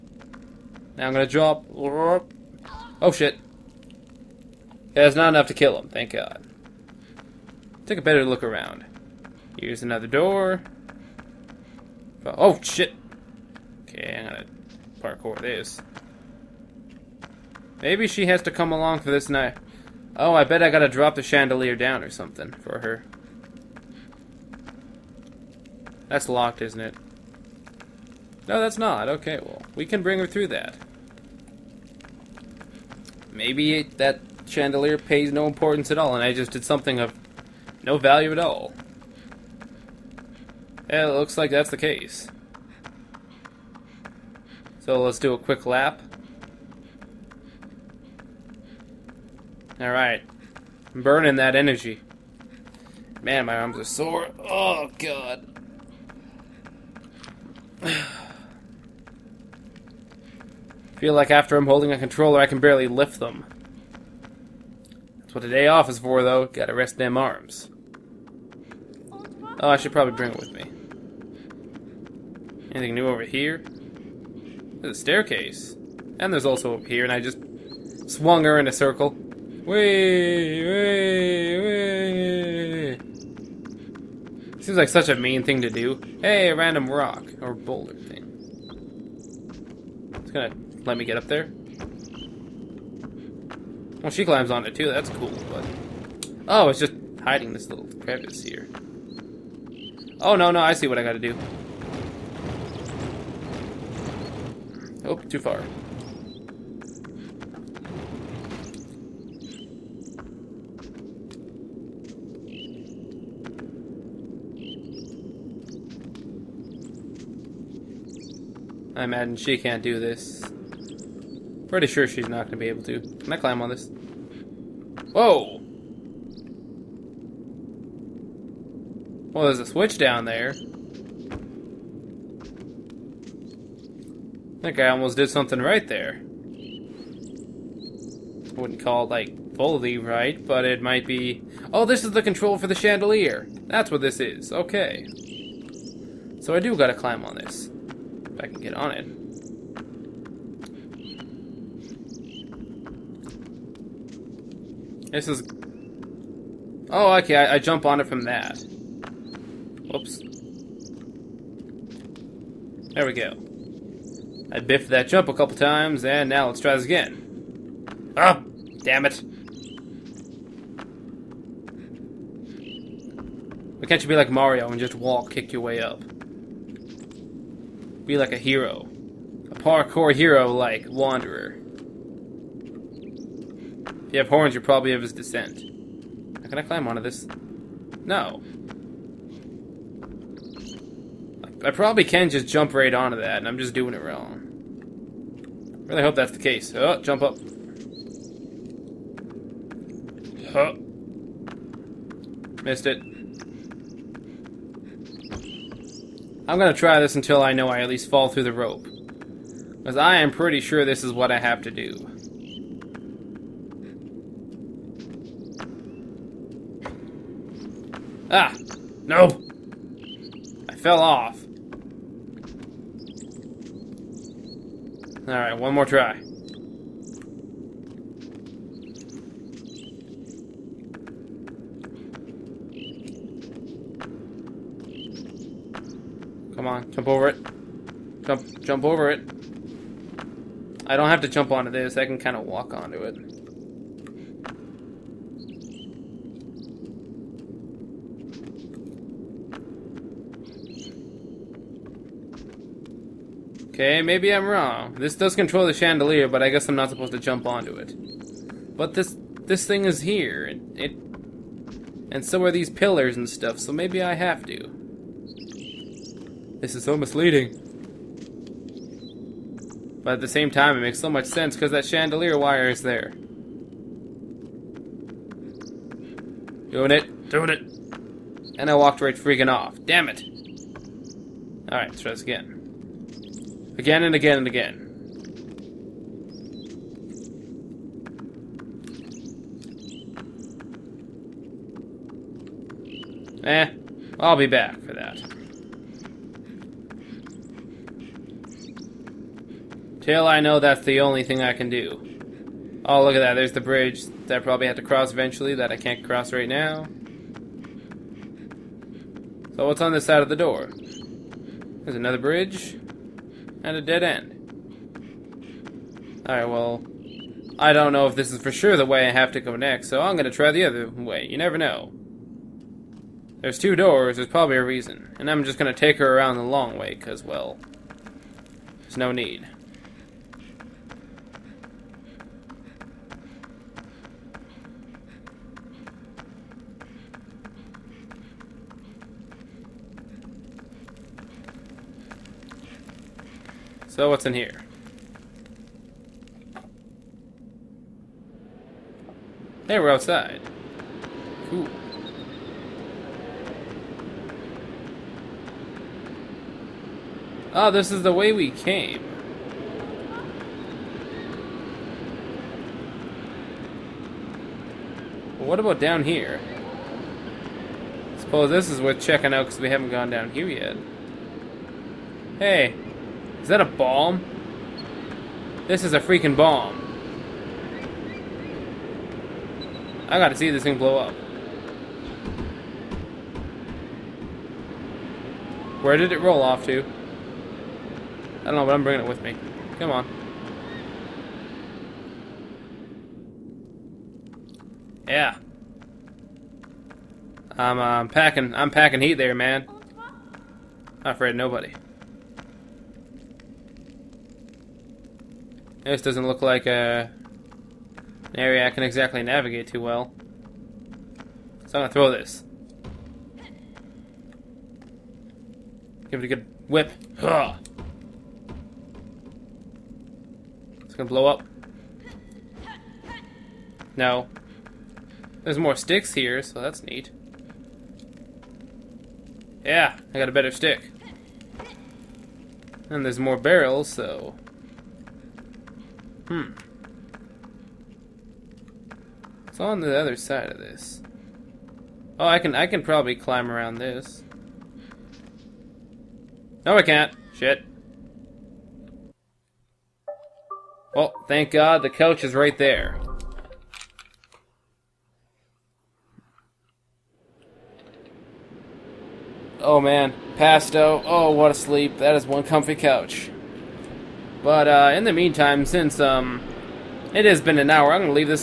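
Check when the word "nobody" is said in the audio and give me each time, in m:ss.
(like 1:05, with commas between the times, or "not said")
6:41.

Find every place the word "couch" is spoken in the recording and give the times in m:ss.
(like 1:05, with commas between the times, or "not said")
7:31, 7:42.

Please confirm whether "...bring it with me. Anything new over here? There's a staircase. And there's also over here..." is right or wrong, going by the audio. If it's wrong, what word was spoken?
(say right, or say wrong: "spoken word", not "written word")
right.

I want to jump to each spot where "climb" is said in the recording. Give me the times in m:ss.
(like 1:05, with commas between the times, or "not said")
1:34, 2:03, 2:26, 3:06, 7:23.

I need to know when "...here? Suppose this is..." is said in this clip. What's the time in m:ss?
6:06.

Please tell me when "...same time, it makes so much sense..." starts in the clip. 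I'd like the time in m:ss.
4:30.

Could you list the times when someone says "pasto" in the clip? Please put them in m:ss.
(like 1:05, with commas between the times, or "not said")
7:40.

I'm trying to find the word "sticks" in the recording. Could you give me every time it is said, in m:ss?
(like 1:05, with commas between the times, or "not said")
7:05, 7:10.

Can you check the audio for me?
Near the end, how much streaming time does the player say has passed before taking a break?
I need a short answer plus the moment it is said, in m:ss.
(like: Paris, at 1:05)
An hour, at 7:47.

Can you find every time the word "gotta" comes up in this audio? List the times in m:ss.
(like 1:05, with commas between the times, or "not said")
0:20, 1:06, 2:26, 6:20.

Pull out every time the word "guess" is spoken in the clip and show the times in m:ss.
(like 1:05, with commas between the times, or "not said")
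4:16.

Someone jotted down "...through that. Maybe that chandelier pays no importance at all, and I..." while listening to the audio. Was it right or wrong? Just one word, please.
right.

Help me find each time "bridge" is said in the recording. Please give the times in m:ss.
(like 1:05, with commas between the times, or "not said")
5:03, 5:12.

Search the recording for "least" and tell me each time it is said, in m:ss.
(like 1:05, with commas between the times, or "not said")
3:27.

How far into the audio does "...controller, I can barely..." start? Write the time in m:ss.
1:01.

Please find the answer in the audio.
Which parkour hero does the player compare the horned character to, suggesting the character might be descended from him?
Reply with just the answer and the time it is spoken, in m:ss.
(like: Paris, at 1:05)
Wanderer, at 3:00.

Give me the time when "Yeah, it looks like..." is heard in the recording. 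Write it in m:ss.
0:40.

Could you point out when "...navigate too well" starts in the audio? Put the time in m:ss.
6:49.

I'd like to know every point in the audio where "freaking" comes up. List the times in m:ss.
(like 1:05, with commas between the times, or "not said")
4:39, 6:16.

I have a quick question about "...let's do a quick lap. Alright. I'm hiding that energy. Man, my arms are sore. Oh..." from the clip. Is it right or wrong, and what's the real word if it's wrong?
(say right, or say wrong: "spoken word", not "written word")
wrong: "burning", not "hiding".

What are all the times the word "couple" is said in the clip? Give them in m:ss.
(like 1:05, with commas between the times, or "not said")
2:45.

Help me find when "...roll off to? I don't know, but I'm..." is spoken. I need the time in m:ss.
6:26.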